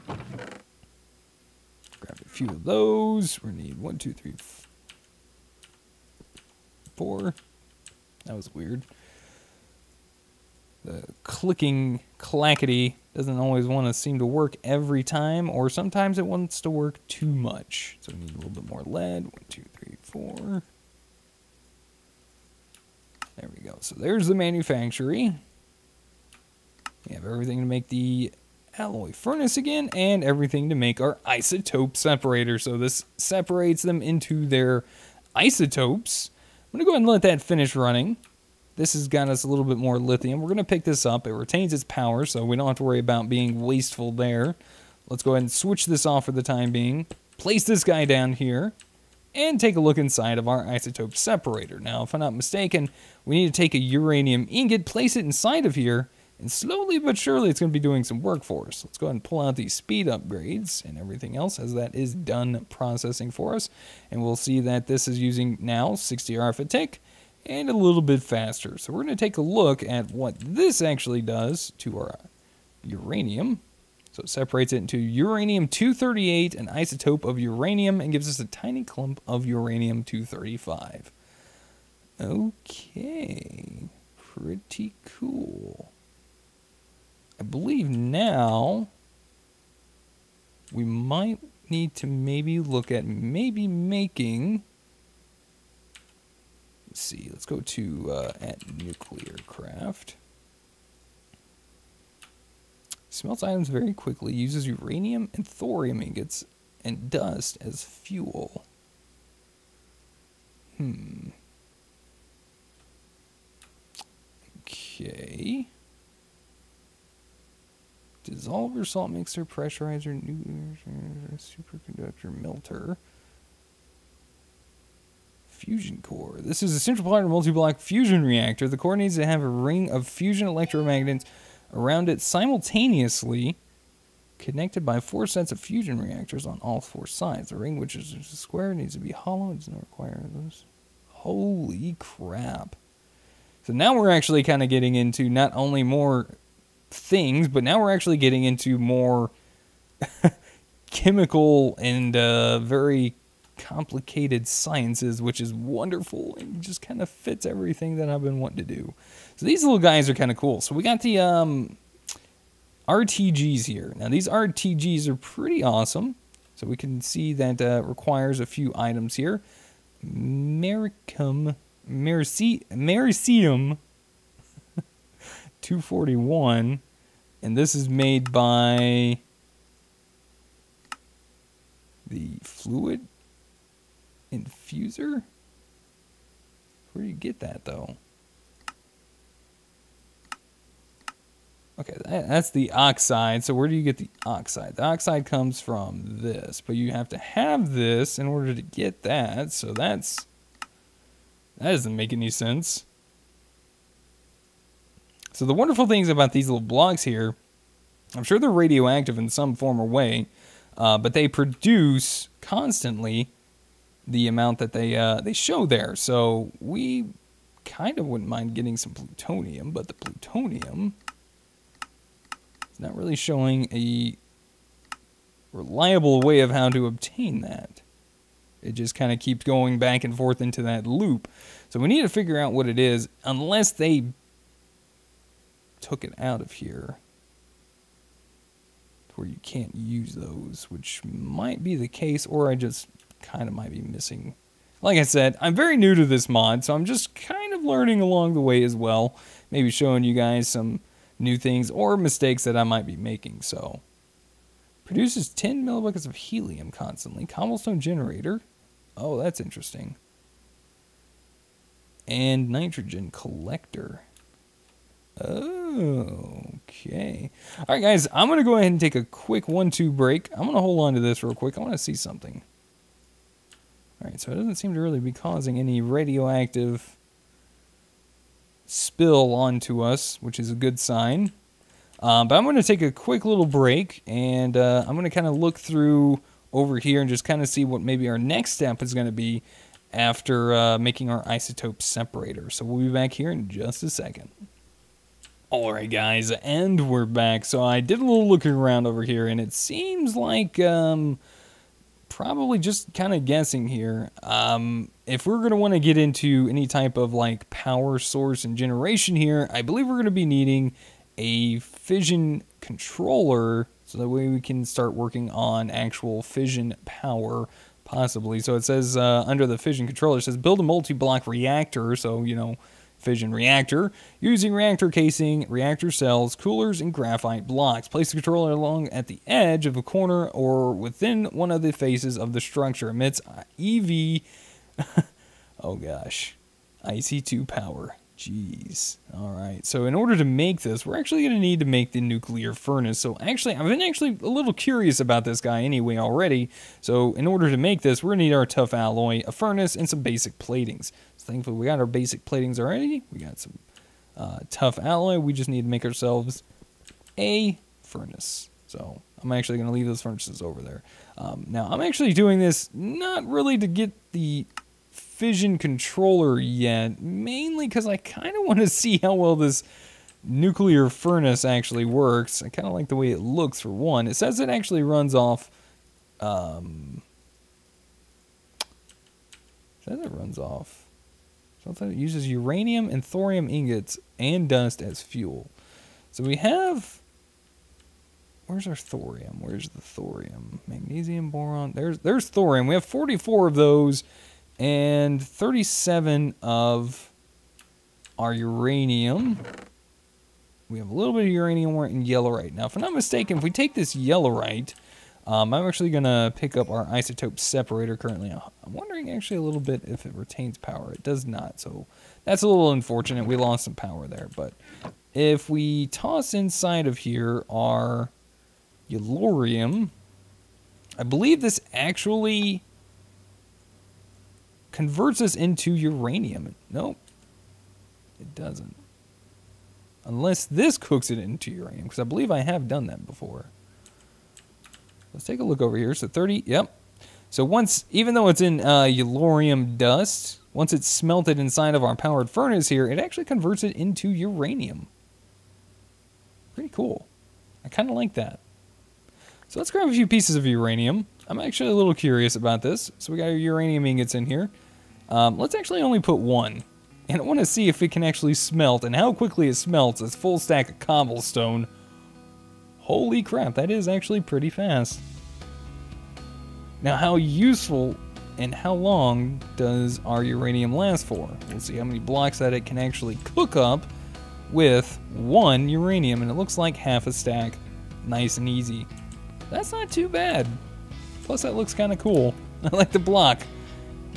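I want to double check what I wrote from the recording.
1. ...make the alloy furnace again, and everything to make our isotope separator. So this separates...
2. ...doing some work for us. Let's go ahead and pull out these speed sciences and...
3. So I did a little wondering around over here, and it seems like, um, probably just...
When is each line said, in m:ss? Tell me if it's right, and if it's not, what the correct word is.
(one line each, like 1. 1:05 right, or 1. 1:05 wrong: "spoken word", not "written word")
1. 0:27 right
2. 0:57 wrong: "upgrades", not "sciences"
3. 4:57 wrong: "looking", not "wondering".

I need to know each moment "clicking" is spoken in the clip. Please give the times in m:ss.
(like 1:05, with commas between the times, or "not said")
0:11.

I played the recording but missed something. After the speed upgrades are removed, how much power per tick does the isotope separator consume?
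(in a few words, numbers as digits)
60 RF.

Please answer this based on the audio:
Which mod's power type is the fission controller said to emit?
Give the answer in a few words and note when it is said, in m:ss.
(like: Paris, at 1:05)
IC2, at 5:36.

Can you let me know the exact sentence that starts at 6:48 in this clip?
I'm wondering actually a little bit if it retains power.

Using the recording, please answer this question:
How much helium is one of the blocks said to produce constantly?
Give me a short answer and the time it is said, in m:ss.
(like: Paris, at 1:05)
10 millibuckets, at 4:15.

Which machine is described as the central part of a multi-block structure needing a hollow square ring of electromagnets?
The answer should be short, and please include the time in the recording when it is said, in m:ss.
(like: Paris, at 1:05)
Fusion core, at 2:05.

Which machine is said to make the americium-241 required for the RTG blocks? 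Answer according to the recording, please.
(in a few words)
the fluid infuser.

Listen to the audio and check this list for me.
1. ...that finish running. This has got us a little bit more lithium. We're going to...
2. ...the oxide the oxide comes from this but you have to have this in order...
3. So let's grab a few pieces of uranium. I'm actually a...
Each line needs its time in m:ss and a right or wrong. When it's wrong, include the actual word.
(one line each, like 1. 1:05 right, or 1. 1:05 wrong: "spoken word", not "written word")
1. 0:37 right
2. 3:13 right
3. 7:29 right.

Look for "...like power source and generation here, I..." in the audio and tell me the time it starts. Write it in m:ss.
5:07.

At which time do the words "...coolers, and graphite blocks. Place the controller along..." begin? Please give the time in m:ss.
5:26.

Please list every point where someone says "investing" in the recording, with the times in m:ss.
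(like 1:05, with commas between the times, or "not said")
not said.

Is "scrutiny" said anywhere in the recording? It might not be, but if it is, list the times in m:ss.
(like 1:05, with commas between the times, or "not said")
not said.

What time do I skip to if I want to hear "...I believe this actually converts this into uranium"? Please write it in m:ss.
7:00.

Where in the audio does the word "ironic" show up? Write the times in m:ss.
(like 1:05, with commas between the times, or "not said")
not said.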